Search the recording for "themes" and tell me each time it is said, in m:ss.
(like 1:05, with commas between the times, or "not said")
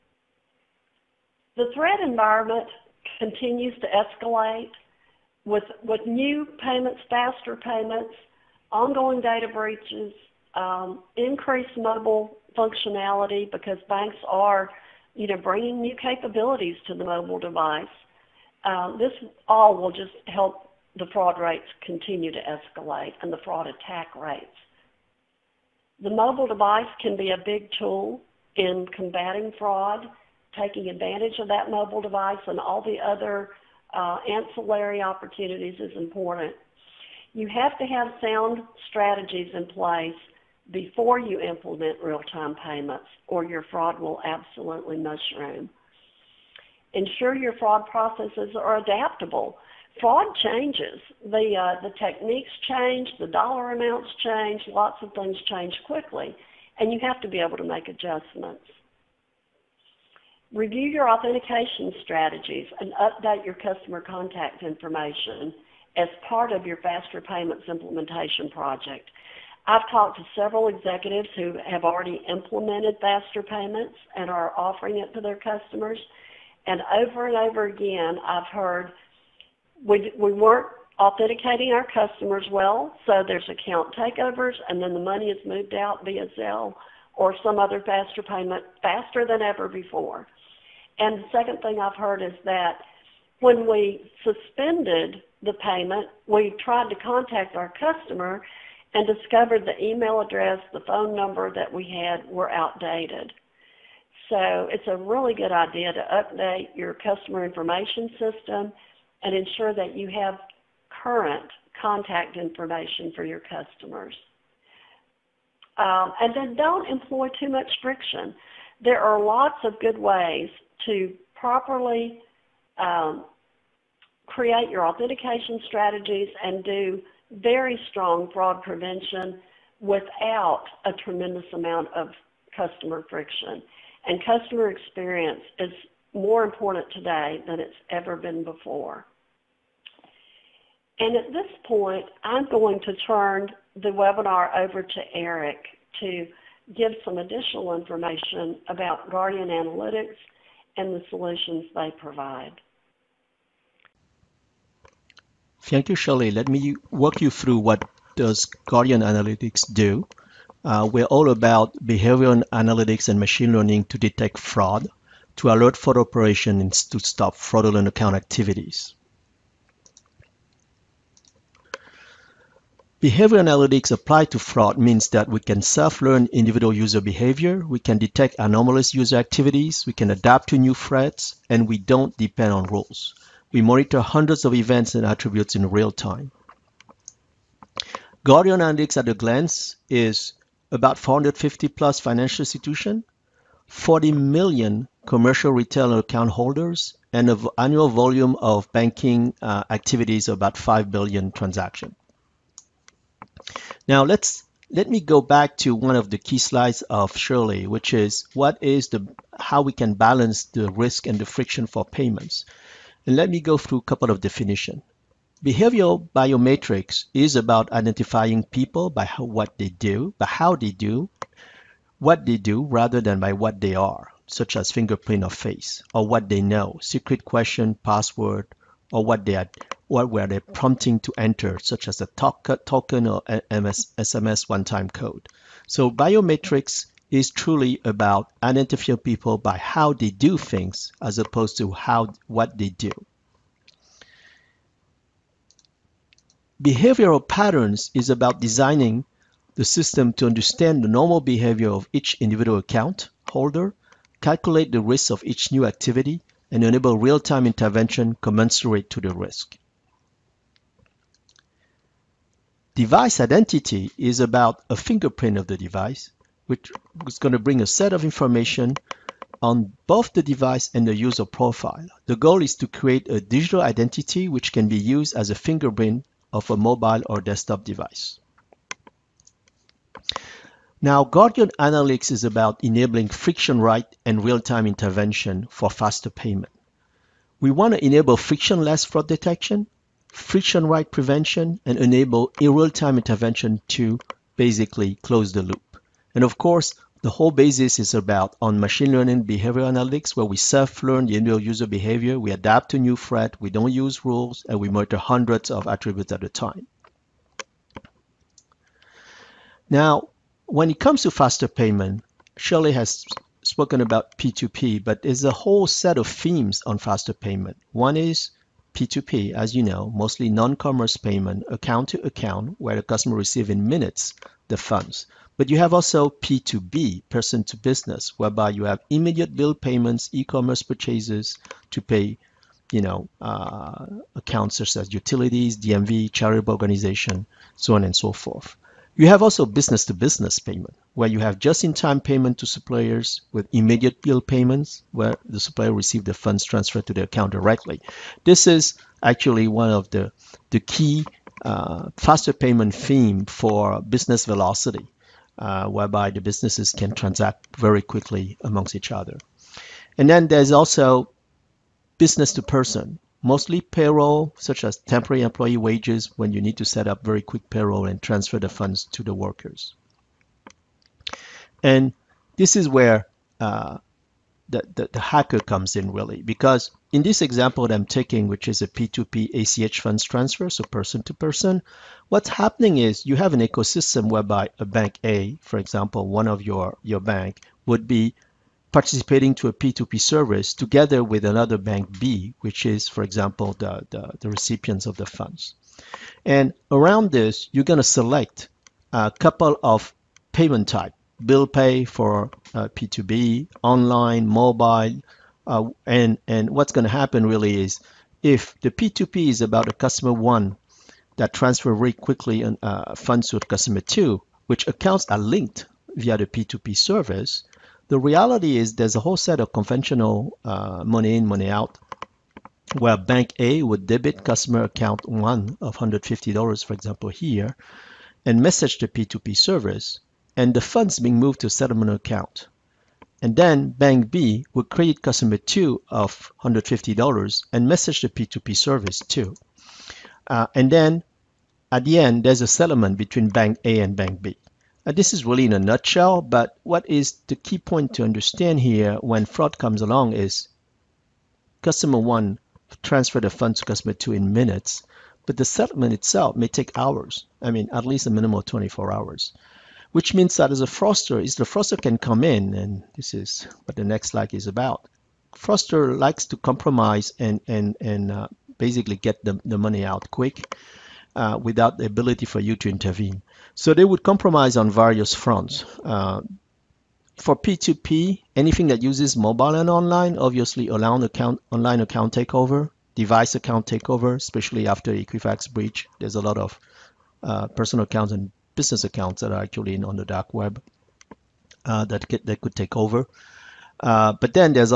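5:16, 5:52.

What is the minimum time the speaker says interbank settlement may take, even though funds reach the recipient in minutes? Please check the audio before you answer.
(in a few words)
24 hours.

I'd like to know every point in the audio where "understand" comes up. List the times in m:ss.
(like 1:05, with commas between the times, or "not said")
4:10, 7:28.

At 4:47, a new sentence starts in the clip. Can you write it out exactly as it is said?
We want to enable frictionless fraud detection, friction right prevention, and enable a real-time intervention to basically close the loop.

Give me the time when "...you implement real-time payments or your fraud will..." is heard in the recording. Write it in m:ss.
0:41.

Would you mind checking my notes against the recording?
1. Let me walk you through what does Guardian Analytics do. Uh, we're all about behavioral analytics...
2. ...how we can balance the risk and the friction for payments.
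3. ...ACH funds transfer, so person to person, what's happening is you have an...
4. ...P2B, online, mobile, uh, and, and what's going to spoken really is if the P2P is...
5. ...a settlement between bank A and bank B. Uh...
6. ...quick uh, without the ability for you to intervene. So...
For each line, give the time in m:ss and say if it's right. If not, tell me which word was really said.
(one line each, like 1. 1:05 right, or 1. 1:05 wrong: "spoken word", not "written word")
1. 2:36 right
2. 3:29 right
3. 6:19 right
4. 6:42 wrong: "happen", not "spoken"
5. 7:22 right
6. 7:50 right.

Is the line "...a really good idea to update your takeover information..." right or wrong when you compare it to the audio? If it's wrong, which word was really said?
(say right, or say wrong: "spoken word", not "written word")
wrong: "customer", not "takeover".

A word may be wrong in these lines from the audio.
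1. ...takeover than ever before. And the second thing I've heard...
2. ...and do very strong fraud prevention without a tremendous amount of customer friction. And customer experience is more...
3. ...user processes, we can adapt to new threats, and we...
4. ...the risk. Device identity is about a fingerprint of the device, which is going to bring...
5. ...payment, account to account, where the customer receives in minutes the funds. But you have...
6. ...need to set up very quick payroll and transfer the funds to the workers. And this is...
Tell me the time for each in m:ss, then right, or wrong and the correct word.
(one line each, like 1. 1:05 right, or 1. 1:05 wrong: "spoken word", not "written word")
1. 1:28 wrong: "faster", not "takeover"
2. 2:06 right
3. 2:58 wrong: "activities", not "processes"
4. 4:19 right
5. 5:20 right
6. 6:06 right.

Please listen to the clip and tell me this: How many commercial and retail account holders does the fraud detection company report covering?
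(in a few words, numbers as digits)
40 million.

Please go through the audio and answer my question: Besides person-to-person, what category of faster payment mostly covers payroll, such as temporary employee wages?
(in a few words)
business to person.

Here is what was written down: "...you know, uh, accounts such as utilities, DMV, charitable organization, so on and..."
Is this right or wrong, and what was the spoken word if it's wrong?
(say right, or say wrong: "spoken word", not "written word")
right.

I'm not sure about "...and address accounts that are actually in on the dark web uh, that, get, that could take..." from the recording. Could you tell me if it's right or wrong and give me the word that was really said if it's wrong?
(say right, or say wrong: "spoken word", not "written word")
wrong: "business", not "address".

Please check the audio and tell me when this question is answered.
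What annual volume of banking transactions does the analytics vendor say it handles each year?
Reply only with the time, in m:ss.
3:20.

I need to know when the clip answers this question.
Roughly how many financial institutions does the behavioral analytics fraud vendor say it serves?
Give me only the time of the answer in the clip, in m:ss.
3:10.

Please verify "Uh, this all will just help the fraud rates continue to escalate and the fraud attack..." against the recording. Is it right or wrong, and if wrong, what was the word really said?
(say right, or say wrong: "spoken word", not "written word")
right.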